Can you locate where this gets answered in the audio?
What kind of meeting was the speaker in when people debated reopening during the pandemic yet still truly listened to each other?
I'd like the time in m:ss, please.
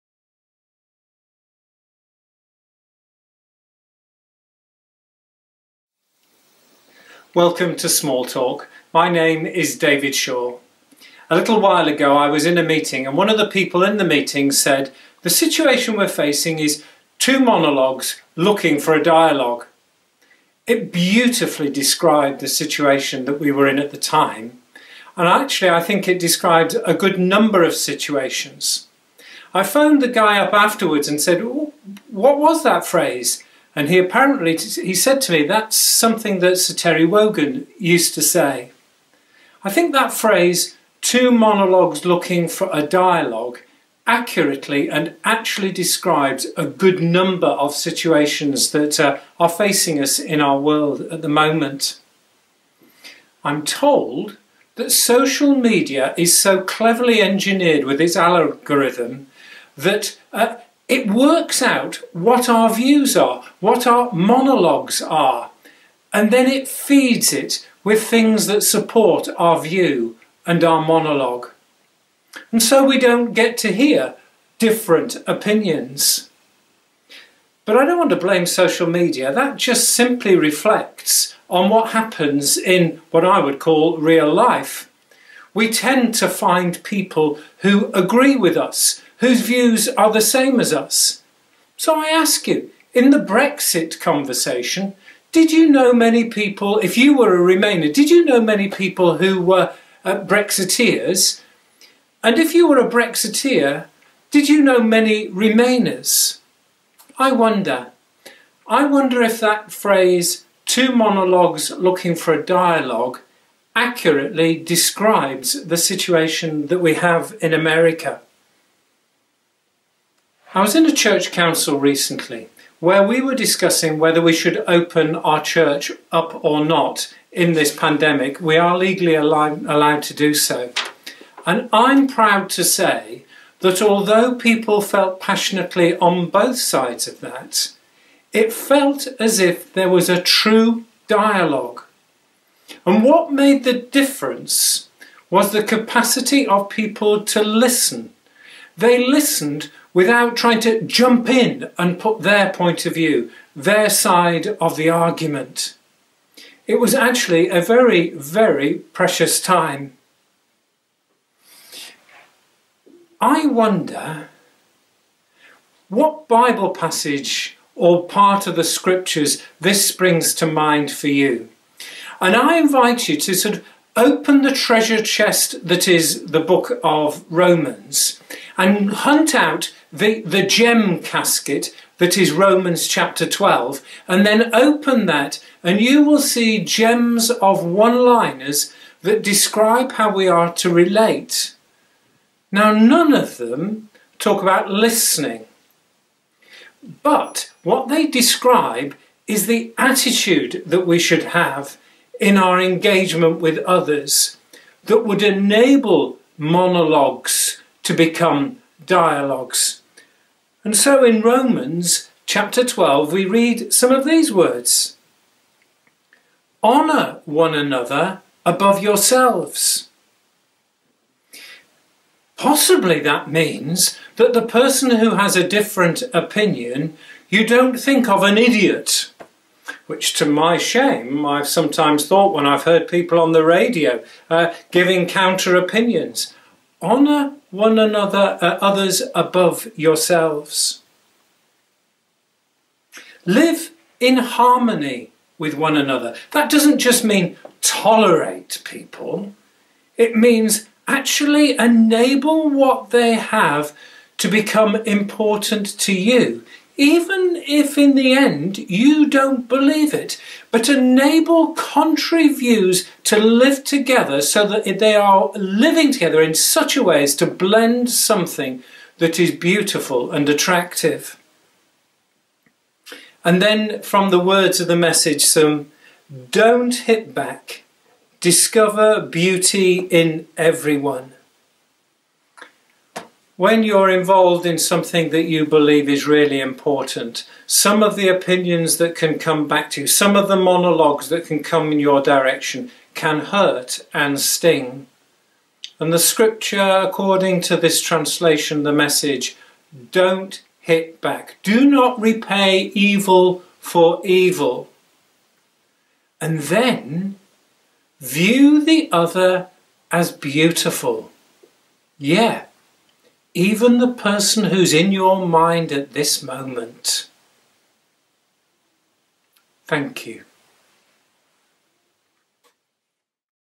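2:00.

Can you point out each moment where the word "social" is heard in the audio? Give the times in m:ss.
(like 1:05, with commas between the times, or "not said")
0:54, 1:18.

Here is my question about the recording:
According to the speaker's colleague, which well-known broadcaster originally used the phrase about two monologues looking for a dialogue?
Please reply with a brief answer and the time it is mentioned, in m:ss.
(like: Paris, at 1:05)
Sir Terry Wogan, at 0:36.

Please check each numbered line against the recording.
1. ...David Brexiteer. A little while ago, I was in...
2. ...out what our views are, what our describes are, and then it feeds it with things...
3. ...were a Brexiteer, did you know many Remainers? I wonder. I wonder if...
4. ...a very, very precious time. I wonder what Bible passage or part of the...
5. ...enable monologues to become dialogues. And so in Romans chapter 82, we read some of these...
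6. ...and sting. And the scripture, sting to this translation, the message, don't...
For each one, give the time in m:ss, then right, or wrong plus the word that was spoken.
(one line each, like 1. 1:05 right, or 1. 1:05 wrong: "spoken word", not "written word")
1. 0:09 wrong: "Shaw", not "Brexiteer"
2. 1:01 wrong: "monologues", not "describes"
3. 1:42 right
4. 2:37 right
5. 3:25 wrong: "12", not "82"
6. 4:53 wrong: "according", not "sting".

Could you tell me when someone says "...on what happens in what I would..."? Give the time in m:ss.
1:21.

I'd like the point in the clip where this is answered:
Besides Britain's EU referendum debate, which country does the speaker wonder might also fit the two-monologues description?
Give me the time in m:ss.
1:57.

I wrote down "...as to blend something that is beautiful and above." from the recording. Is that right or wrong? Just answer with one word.
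wrong.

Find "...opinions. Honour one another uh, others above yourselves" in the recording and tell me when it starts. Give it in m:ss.
3:55.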